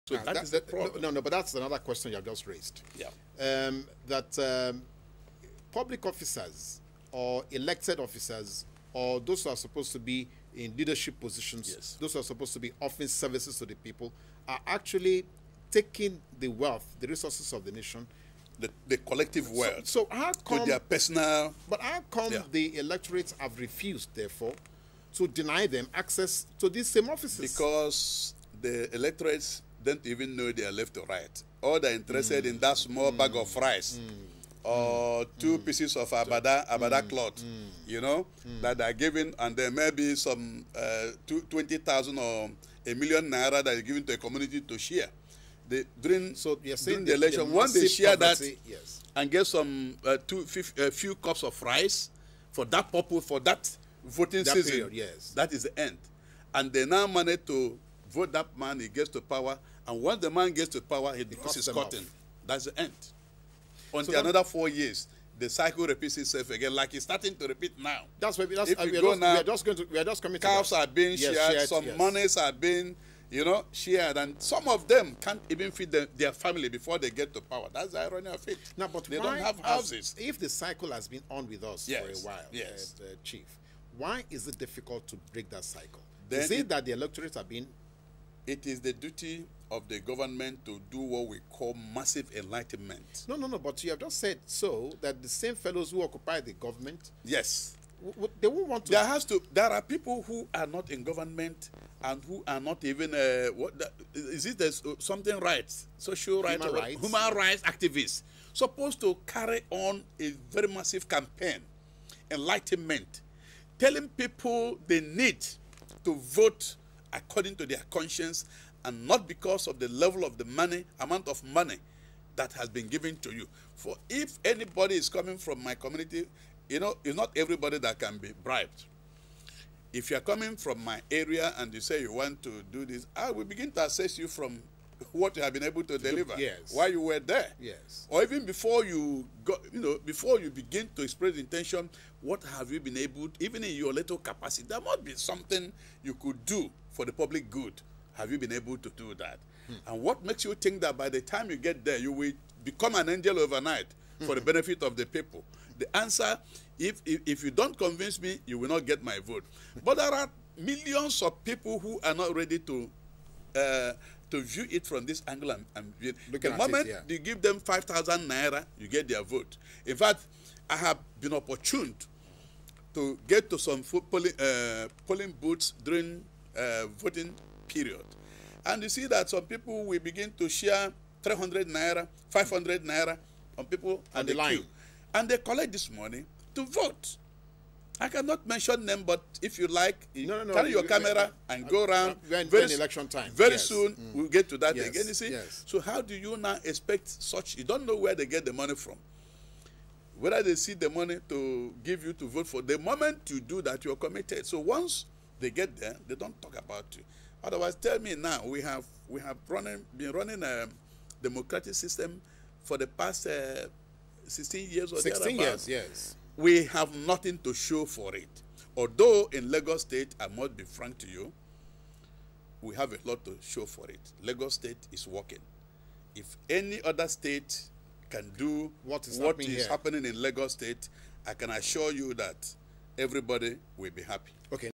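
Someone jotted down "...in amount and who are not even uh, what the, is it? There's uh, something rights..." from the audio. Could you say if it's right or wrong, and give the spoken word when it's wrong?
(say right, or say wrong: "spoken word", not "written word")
wrong: "government", not "amount".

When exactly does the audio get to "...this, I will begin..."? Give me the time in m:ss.
2:12.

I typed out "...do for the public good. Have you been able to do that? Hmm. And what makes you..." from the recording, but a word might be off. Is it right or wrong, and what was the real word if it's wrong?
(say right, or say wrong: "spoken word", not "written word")
right.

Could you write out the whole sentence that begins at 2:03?
For if anybody is coming from my community, you know, it's not everybody that can be bribed.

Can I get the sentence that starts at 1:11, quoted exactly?
monies are being, you know, shared, and some of them can't even feed their family before they get to power.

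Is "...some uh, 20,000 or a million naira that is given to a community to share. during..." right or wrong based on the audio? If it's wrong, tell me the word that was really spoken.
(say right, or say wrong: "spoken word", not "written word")
right.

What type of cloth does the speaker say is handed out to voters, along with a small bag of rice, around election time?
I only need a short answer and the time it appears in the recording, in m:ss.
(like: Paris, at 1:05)
abada, at 0:36.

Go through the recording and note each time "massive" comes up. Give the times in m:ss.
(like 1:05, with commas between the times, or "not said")
1:31, 1:50.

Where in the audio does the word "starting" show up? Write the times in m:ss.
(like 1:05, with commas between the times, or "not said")
1:07.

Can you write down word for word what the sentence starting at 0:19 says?
So, so how come their personal?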